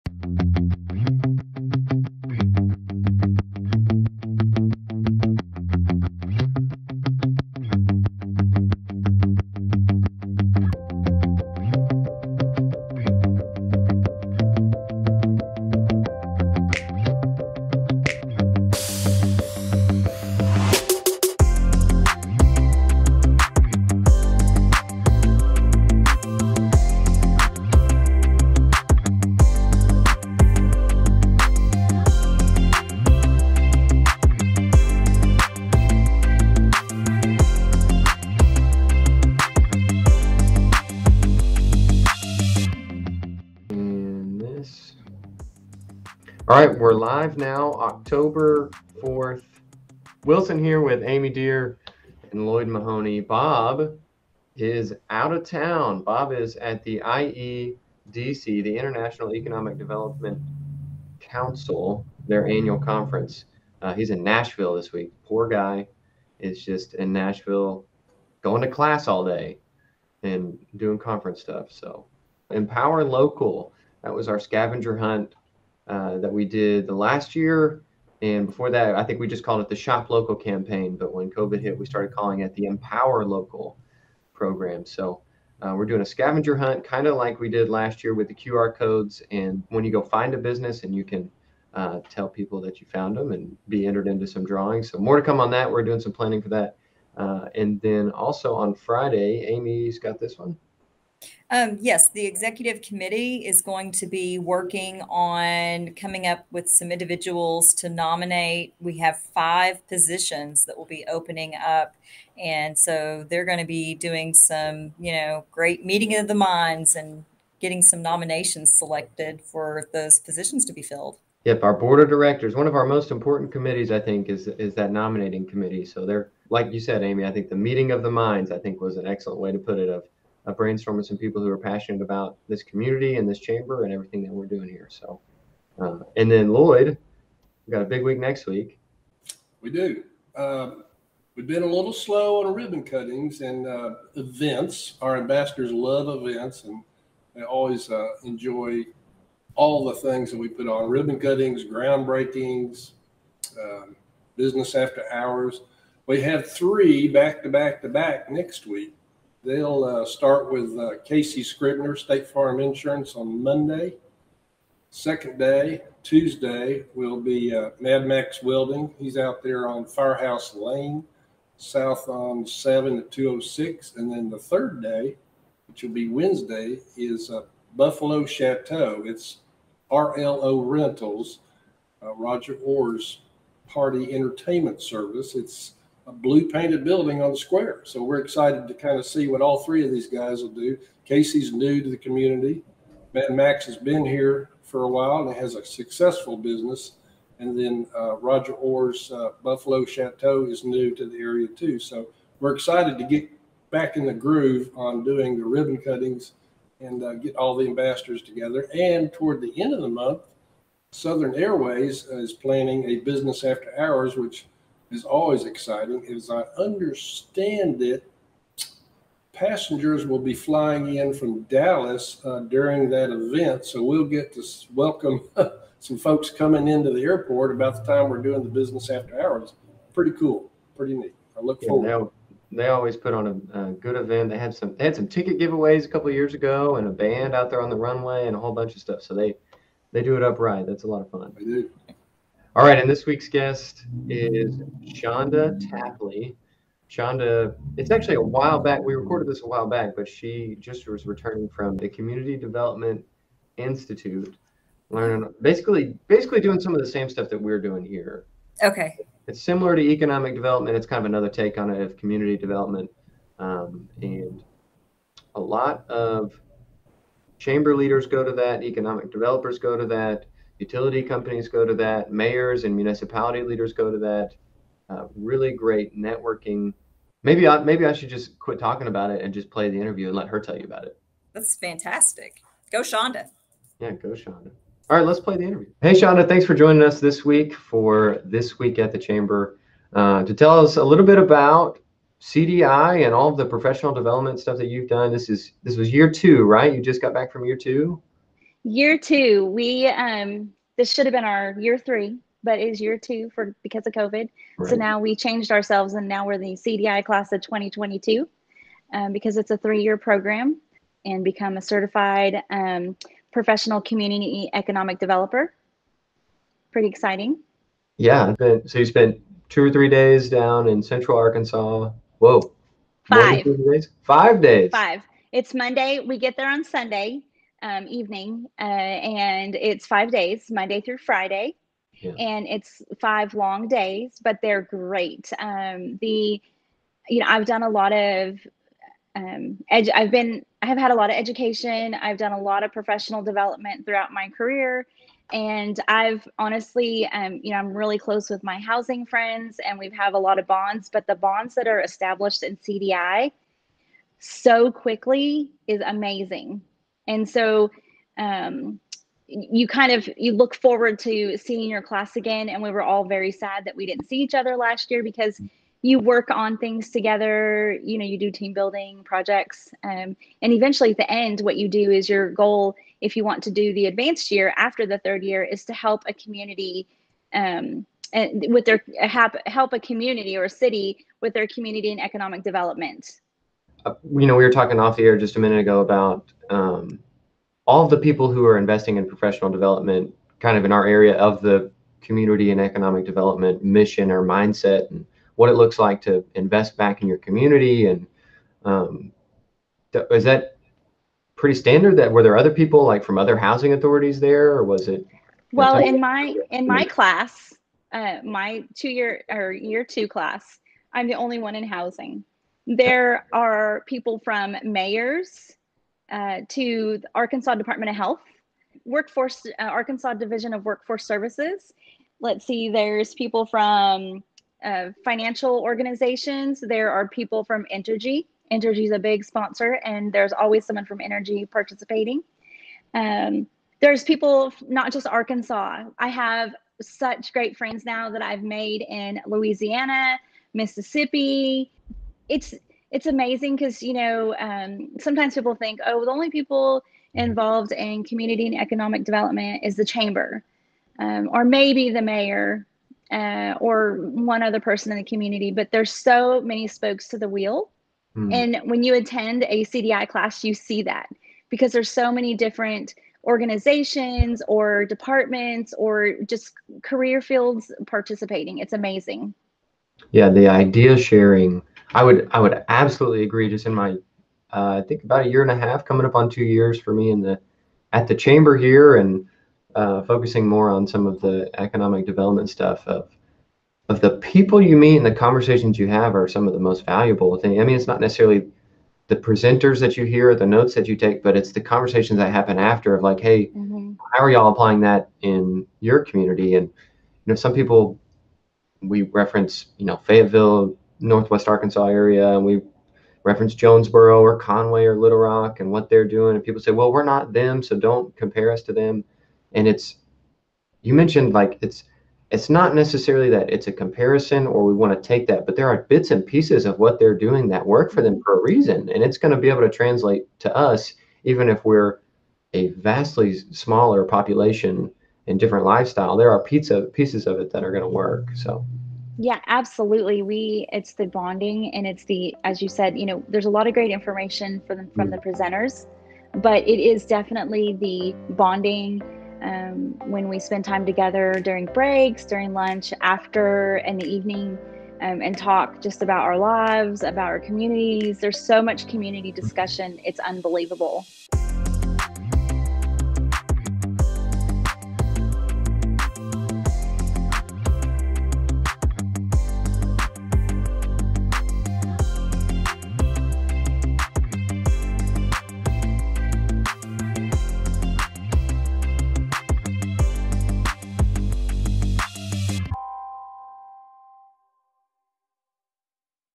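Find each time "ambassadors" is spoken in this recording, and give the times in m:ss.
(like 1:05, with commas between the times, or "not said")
2:25, 3:27.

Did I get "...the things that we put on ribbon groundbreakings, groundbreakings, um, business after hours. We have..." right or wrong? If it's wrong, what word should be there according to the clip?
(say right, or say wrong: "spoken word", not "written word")
wrong: "cuttings", not "groundbreakings".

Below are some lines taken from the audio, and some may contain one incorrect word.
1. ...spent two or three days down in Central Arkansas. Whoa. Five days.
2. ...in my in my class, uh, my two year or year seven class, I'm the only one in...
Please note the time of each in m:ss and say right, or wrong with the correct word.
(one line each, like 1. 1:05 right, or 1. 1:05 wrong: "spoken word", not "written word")
1. 5:18 right
2. 6:45 wrong: "two", not "seven".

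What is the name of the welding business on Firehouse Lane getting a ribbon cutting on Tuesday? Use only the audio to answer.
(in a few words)
Mad Max Welding.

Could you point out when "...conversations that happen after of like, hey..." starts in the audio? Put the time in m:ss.
8:11.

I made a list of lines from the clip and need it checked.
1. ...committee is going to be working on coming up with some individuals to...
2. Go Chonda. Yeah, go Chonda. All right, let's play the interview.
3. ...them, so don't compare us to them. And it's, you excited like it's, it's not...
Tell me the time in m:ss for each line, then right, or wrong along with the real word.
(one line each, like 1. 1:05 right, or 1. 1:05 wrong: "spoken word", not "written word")
1. 1:42 right
2. 4:42 right
3. 8:27 wrong: "mentioned", not "excited".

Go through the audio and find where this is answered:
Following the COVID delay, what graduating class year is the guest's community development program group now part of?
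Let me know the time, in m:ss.
5:07.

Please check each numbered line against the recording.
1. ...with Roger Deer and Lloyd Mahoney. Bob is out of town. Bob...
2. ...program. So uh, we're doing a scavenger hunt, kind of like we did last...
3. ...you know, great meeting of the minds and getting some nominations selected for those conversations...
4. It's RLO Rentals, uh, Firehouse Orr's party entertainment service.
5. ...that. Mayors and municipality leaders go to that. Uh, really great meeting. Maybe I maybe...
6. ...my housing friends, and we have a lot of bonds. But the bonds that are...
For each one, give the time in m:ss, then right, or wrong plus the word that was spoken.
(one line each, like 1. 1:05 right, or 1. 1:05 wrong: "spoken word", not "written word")
1. 0:50 wrong: "Amy", not "Roger"
2. 1:24 right
3. 1:54 wrong: "positions", not "conversations"
4. 2:59 wrong: "Roger", not "Firehouse"
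5. 4:31 wrong: "networking", not "meeting"
6. 5:48 right.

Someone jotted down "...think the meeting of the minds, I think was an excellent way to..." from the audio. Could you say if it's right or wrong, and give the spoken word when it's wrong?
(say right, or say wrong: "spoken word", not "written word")
right.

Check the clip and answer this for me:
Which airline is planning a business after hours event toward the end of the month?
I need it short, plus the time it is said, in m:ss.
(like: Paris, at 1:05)
Southern Airways, at 3:30.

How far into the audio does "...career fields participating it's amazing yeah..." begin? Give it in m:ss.
7:46.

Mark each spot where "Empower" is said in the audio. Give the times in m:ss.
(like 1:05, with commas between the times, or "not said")
1:12, 1:22.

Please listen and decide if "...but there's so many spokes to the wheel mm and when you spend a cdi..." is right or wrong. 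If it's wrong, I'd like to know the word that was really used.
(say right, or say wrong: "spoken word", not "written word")
wrong: "attend", not "spend".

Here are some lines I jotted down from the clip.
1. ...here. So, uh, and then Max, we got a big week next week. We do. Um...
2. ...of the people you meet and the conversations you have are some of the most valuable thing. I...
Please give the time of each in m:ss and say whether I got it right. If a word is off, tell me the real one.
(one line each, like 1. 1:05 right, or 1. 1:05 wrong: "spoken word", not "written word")
1. 2:14 wrong: "Lloyd", not "Max"
2. 8:03 right.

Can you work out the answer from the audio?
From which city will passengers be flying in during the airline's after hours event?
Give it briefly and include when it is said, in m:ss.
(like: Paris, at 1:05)
Dallas, at 3:41.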